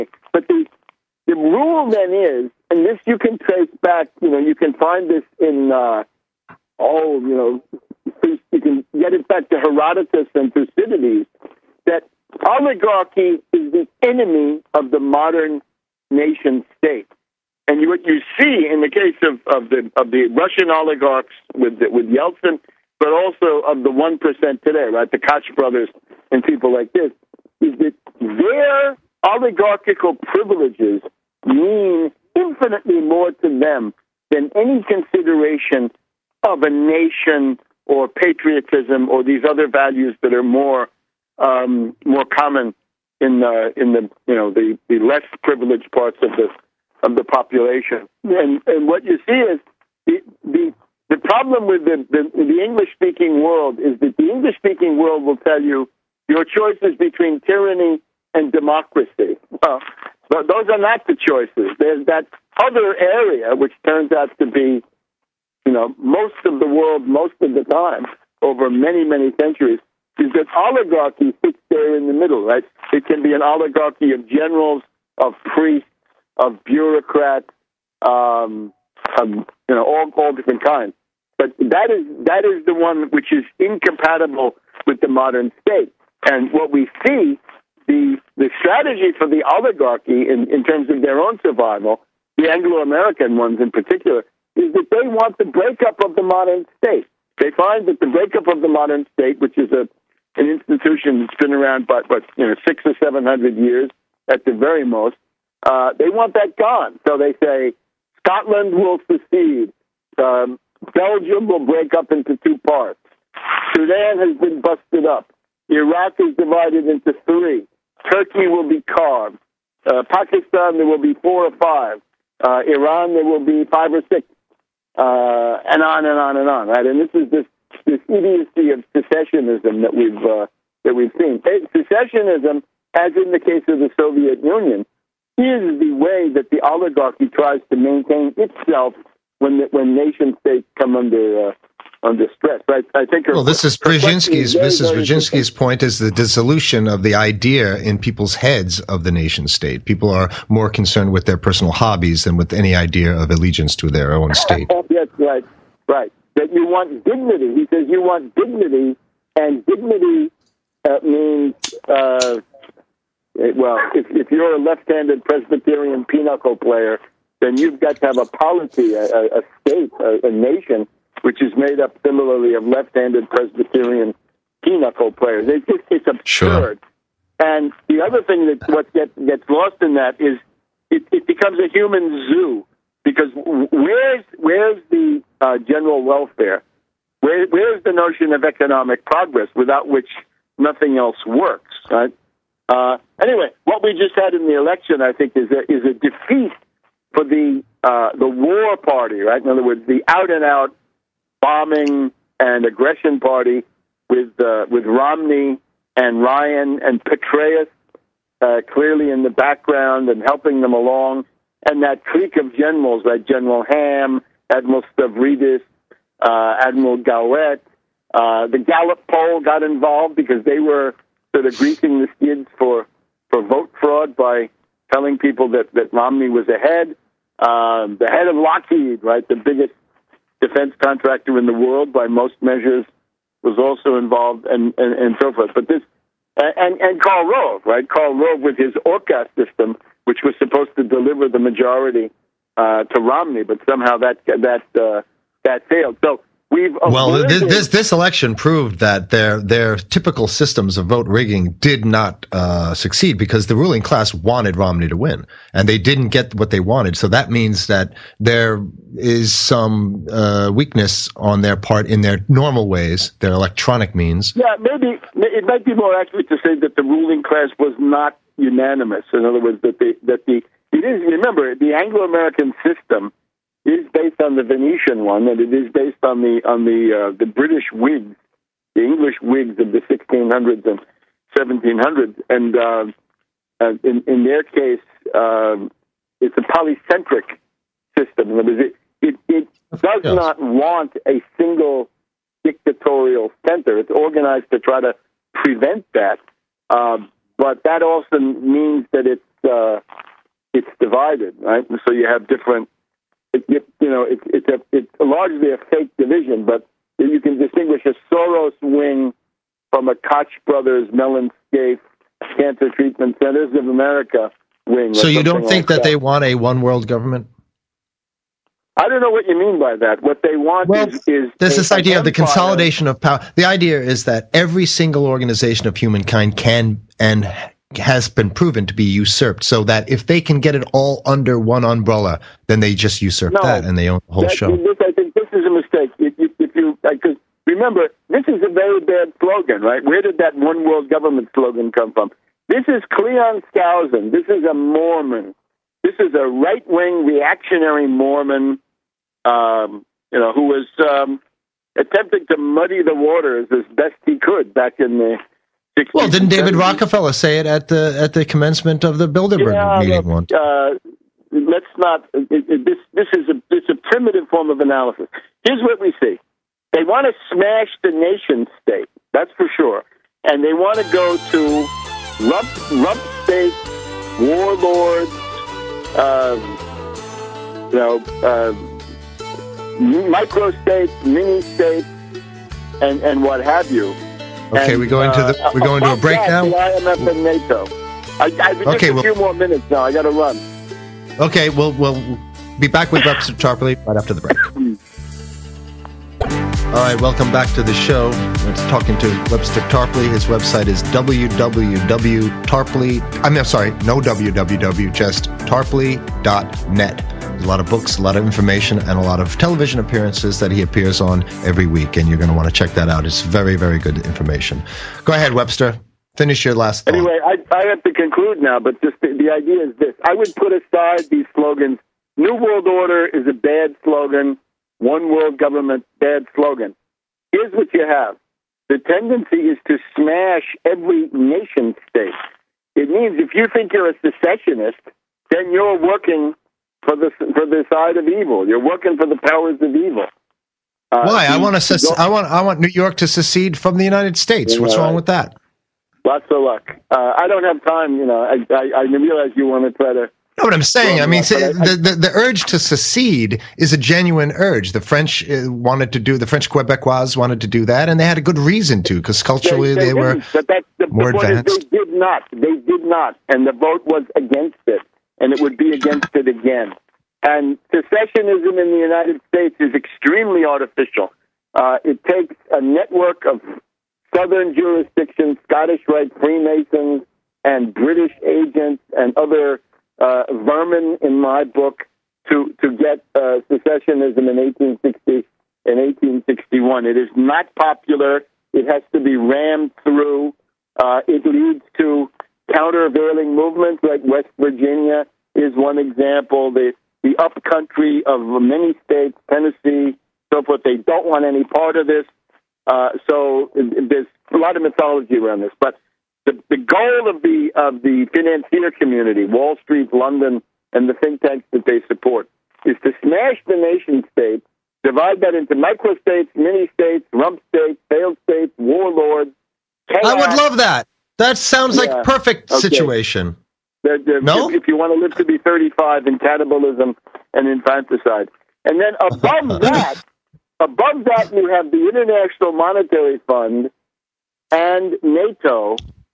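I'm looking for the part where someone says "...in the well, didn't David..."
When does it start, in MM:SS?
05:54.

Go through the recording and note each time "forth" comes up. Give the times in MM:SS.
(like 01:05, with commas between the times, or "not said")
03:55, 08:20.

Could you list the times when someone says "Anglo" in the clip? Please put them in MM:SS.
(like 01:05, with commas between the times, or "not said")
01:32, 04:31.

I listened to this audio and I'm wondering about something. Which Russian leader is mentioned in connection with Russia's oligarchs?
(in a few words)
Yeltsin.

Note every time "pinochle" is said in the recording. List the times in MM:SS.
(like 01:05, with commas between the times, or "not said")
02:46, 02:54.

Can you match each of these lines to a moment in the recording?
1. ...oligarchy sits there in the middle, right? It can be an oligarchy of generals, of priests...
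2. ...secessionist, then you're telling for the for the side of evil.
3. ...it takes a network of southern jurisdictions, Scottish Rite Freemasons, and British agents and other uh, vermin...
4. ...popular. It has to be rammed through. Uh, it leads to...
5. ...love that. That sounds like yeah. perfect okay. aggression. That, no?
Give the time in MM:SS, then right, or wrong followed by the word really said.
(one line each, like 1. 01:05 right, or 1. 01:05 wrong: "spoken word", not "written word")
1. 01:10 right
2. 07:14 wrong: "working", not "telling"
3. 07:51 right
4. 08:07 right
5. 08:40 wrong: "situation", not "aggression".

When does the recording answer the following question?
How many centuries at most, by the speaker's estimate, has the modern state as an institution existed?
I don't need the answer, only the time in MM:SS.
01:42.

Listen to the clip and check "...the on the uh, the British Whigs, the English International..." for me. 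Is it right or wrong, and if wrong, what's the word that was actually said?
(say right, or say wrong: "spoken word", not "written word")
wrong: "Whigs", not "International".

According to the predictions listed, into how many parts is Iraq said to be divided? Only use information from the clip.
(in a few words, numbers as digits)
3.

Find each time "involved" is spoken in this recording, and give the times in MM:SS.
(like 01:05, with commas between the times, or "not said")
03:39, 03:53.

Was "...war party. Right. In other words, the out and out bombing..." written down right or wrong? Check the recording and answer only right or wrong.
right.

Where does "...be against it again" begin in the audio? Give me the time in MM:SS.
07:45.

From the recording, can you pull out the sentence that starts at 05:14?
So you don't think like that, that, they want a one world government?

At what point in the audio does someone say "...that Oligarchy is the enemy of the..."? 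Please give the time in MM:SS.
00:11.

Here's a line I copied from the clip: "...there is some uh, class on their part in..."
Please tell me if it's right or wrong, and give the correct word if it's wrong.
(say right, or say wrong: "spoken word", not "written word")
wrong: "weakness", not "class".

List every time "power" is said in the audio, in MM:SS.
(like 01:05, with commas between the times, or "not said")
05:22, 07:19.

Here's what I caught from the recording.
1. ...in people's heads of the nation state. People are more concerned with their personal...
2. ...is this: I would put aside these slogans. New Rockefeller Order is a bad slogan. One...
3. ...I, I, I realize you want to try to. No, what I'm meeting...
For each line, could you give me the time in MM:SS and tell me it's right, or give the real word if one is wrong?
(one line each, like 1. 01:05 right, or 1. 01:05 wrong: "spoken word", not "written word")
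1. 02:27 right
2. 06:59 wrong: "World", not "Rockefeller"
3. 07:28 wrong: "saying", not "meeting".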